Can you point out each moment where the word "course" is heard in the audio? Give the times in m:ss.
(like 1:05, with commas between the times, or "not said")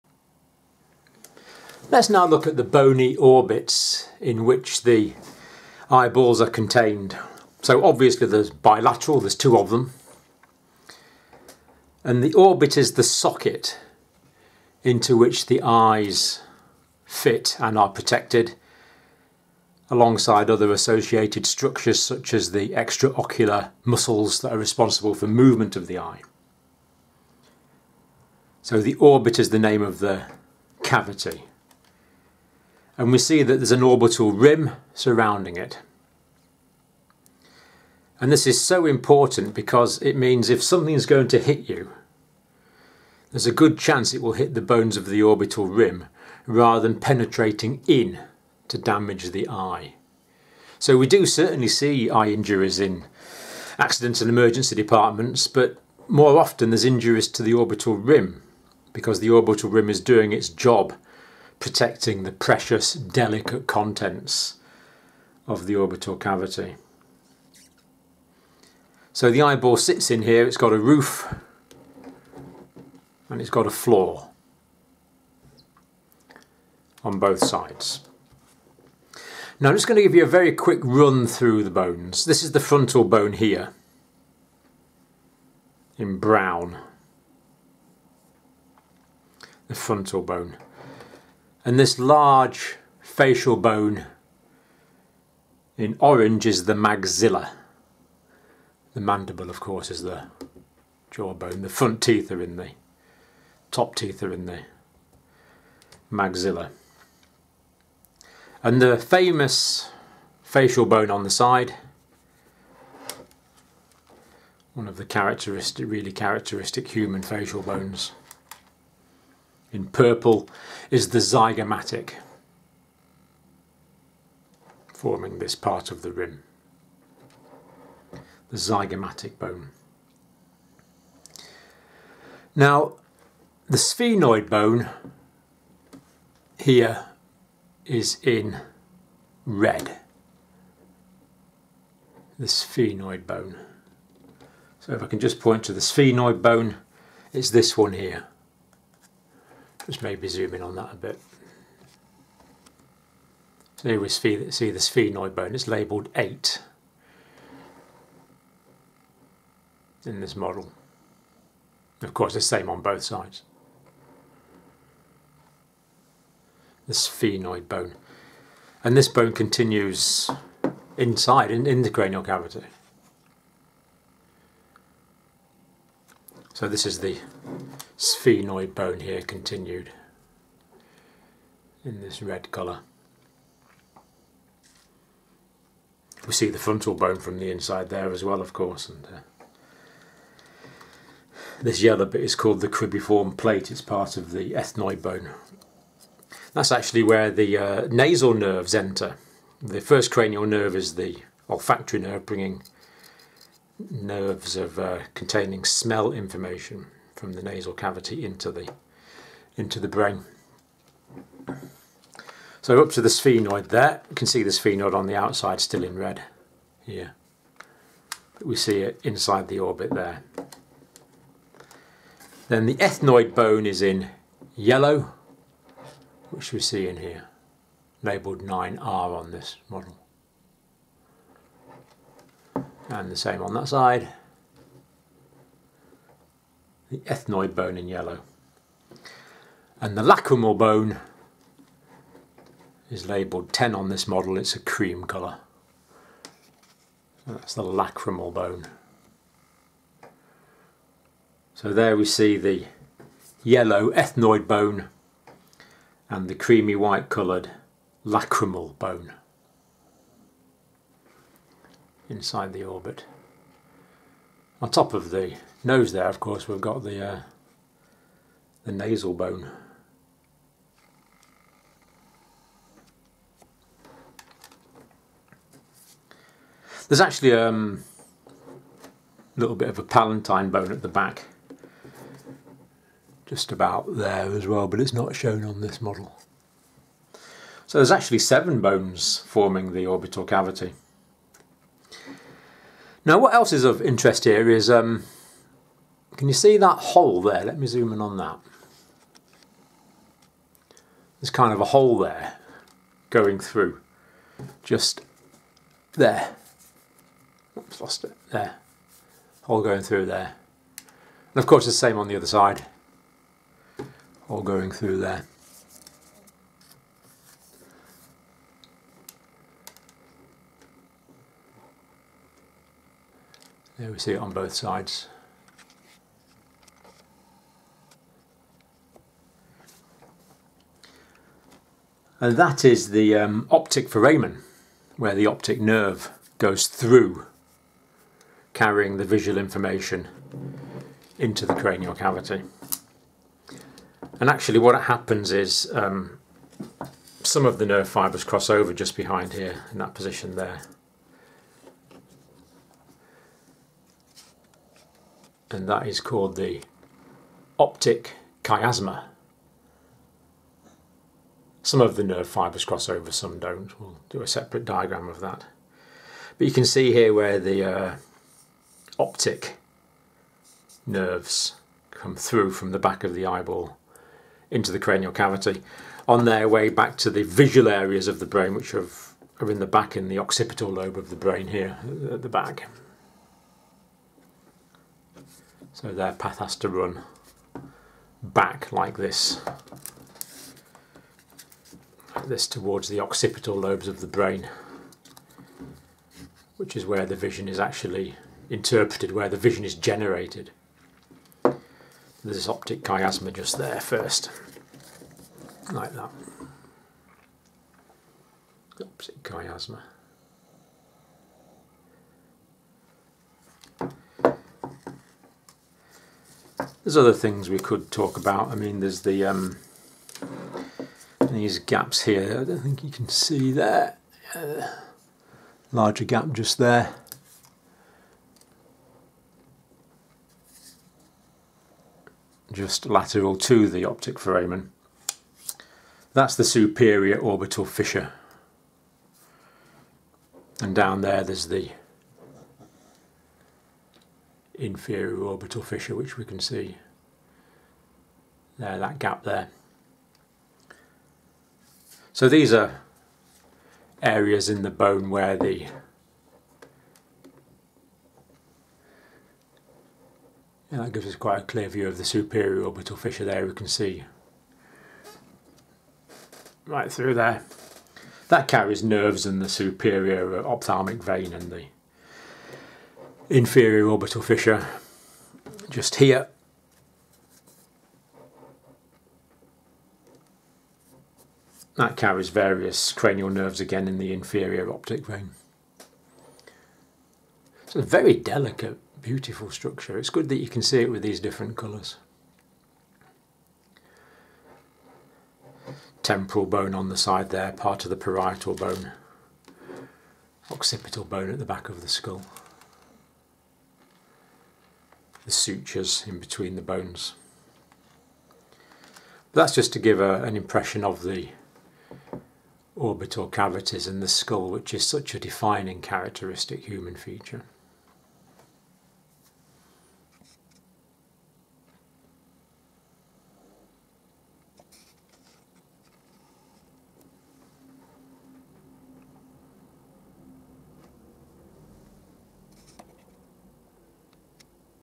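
1:39, 2:42, 3:08, 4:26, 5:11.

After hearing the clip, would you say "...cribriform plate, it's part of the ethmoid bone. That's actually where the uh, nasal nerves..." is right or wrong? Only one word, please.
right.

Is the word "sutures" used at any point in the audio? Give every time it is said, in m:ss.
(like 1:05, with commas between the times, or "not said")
8:25.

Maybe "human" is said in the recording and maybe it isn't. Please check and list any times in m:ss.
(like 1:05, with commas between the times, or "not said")
1:56, 8:36.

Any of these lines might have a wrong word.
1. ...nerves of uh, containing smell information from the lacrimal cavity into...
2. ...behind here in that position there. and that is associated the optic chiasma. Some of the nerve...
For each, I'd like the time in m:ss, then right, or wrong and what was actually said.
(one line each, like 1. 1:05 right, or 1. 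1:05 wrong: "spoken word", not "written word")
1. 3:23 wrong: "nasal", not "lacrimal"
2. 5:48 wrong: "called", not "associated".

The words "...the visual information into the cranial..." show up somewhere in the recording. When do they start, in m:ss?
5:38.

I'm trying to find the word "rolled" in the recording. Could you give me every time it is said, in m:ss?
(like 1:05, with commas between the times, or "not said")
not said.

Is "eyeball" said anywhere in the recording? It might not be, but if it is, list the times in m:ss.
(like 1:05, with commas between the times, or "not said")
0:05, 1:09, 6:13.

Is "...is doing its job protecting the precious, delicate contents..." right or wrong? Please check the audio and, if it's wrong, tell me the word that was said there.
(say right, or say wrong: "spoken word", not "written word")
right.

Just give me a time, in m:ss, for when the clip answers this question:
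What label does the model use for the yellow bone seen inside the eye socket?
3:48.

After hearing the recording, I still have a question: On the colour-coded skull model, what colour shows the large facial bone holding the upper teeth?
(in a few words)
Orange.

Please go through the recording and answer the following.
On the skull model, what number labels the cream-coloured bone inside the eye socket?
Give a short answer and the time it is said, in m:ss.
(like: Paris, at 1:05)
10, at 4:03.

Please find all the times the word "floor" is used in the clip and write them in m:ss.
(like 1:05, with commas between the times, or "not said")
1:13.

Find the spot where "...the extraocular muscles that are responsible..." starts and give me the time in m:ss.
0:22.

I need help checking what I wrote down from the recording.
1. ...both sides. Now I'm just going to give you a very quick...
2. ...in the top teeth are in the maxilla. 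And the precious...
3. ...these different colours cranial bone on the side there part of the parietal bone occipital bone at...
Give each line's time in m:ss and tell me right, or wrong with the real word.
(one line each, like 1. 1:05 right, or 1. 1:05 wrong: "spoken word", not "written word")
1. 1:17 right
2. 1:42 wrong: "famous", not "precious"
3. 8:11 wrong: "temporal", not "cranial".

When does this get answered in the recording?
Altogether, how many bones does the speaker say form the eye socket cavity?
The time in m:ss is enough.
4:48.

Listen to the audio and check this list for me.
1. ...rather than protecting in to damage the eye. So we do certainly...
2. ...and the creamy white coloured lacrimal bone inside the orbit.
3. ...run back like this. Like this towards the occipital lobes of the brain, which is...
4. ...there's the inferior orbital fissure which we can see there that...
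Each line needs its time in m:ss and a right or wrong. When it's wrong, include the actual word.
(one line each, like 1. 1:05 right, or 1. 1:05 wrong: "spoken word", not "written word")
1. 0:46 wrong: "penetrating", not "protecting"
2. 4:16 right
3. 6:26 right
4. 7:21 right.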